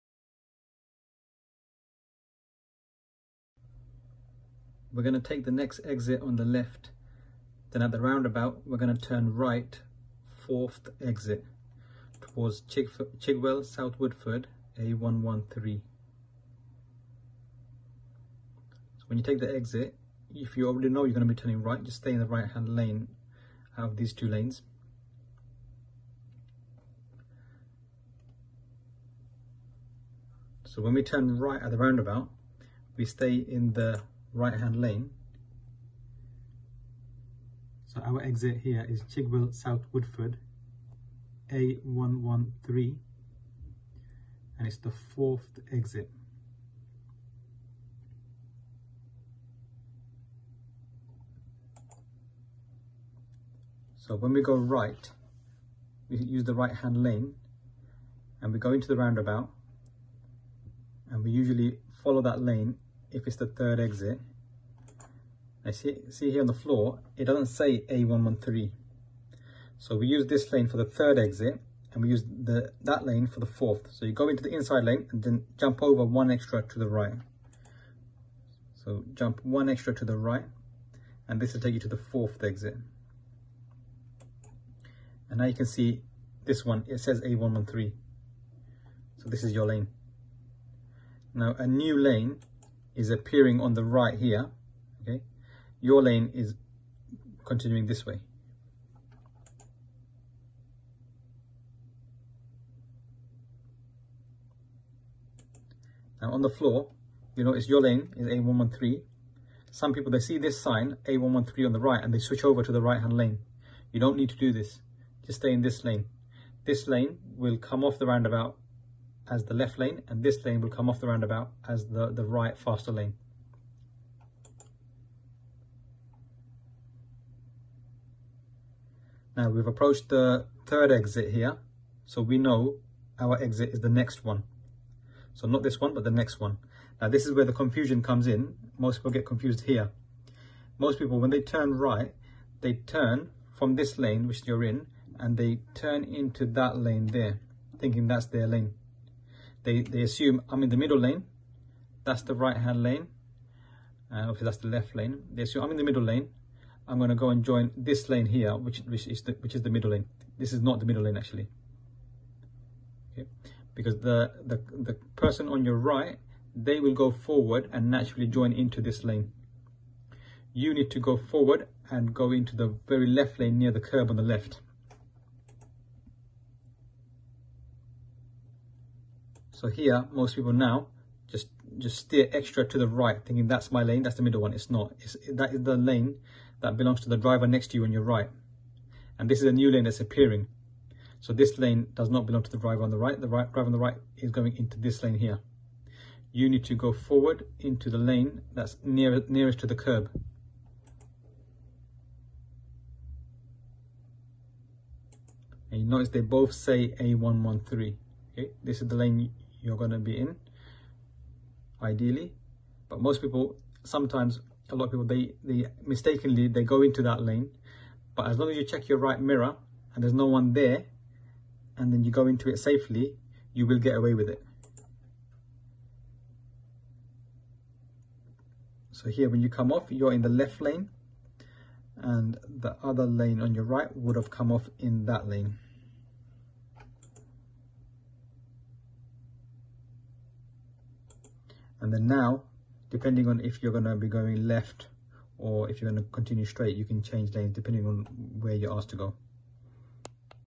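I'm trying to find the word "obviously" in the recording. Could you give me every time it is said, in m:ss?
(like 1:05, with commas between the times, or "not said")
2:34.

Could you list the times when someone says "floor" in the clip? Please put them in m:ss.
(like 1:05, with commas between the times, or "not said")
1:06, 1:46.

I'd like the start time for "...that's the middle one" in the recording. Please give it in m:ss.
3:04.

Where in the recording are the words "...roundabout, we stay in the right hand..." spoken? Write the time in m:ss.
0:31.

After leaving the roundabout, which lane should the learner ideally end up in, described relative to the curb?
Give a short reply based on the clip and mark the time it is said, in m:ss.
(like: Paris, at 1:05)
the very left lane, at 2:52.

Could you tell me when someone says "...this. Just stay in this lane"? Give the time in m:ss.
1:54.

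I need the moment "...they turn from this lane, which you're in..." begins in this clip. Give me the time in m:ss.
2:22.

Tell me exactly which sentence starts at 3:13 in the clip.
The right, driver on the right is going into this lane here.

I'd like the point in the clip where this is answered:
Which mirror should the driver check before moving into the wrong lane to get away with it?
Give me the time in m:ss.
3:38.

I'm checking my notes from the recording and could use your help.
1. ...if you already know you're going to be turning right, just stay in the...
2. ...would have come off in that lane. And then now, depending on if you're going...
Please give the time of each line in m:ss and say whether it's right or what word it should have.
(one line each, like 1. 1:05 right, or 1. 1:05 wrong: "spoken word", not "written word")
1. 0:20 right
2. 3:53 right.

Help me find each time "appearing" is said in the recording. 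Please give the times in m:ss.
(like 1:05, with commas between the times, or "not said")
1:33, 3:09.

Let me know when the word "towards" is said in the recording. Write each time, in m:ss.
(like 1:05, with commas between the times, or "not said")
0:12.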